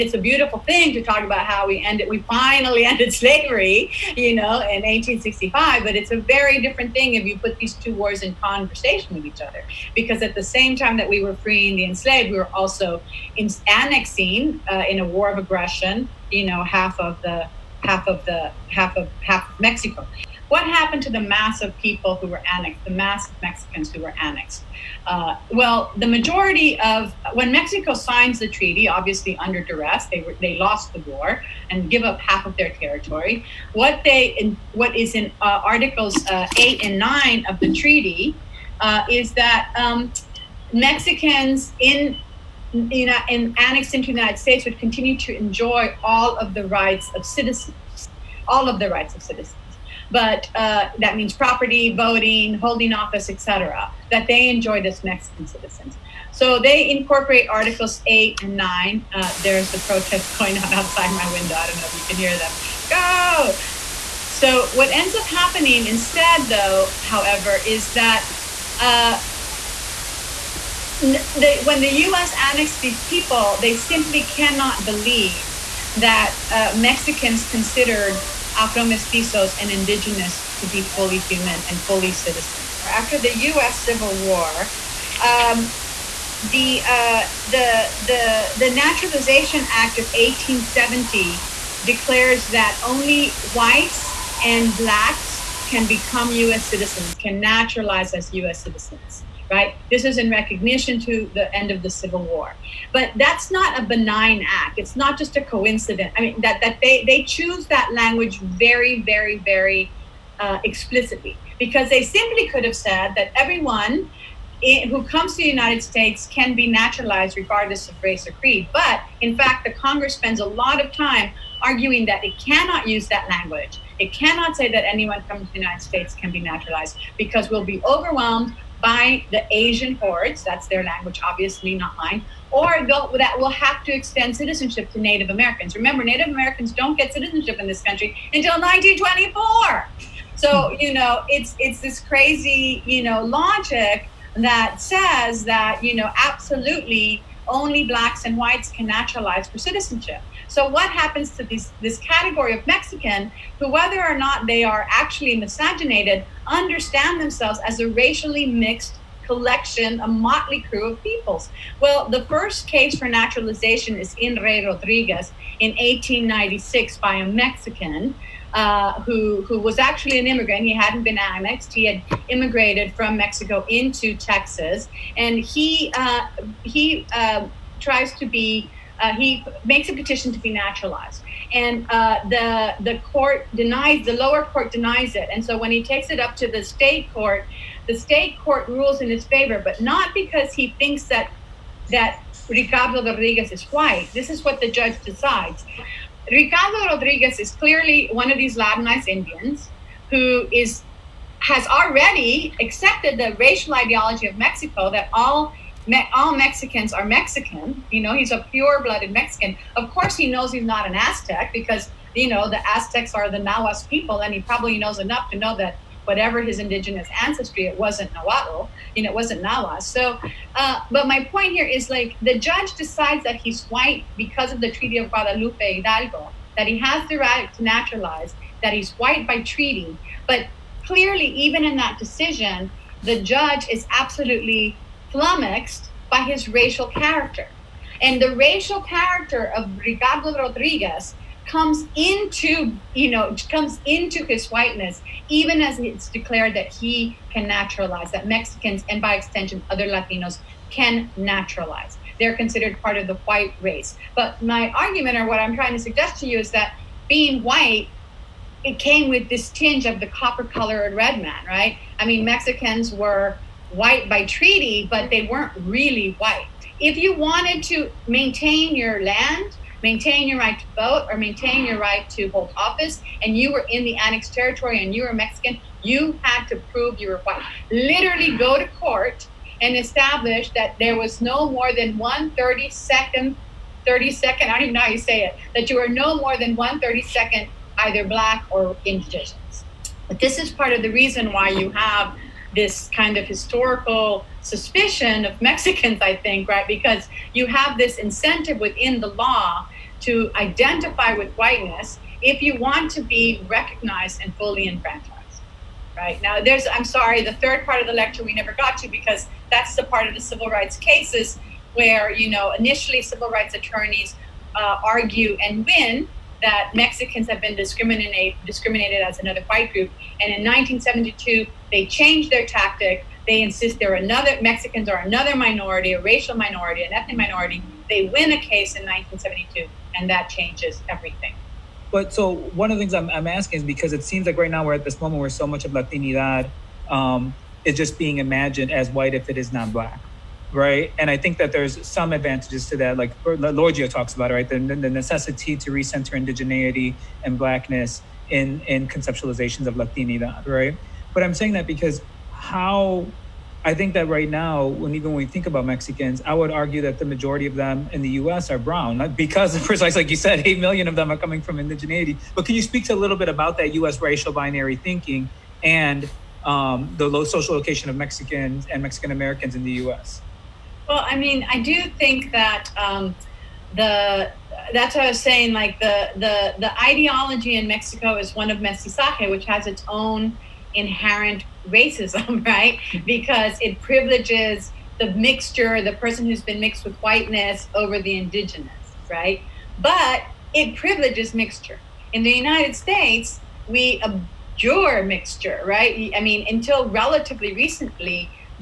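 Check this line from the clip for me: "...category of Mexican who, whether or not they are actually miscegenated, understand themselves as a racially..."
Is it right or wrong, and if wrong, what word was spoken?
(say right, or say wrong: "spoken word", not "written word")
right.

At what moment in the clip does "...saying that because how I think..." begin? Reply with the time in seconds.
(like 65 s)
351 s.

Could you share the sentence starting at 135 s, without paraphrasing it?
Remember, Native Americans don't get citizenship in this country until 1924.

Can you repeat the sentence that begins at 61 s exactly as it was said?
I don't know if you can hear them.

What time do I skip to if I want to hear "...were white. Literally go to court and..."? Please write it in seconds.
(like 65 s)
277 s.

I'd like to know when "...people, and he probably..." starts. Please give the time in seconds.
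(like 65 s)
213 s.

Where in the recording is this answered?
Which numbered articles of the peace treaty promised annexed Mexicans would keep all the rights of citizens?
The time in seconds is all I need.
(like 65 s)
57 s.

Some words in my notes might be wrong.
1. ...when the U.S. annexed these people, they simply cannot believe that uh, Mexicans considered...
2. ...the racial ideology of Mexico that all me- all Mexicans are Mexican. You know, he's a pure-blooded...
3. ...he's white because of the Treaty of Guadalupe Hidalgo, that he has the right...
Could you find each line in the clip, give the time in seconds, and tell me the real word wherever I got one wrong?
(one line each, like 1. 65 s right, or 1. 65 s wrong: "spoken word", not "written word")
1. 71 s right
2. 203 s right
3. 223 s right.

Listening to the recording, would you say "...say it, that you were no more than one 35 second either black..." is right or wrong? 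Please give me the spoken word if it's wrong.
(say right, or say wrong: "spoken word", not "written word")
wrong: "30", not "35".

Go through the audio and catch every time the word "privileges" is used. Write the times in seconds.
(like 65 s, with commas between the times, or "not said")
383 s, 390 s.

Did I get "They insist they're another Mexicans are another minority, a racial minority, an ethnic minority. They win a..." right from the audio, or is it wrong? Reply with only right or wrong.
right.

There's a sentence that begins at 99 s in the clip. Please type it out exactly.
This is in recognition to the end of the Civil War.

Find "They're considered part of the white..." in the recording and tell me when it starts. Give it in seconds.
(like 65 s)
252 s.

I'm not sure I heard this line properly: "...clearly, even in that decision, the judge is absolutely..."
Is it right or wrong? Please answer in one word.
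right.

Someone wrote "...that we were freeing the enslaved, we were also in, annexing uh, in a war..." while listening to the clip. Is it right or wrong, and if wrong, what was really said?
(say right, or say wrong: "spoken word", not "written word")
right.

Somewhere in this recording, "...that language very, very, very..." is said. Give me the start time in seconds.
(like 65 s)
107 s.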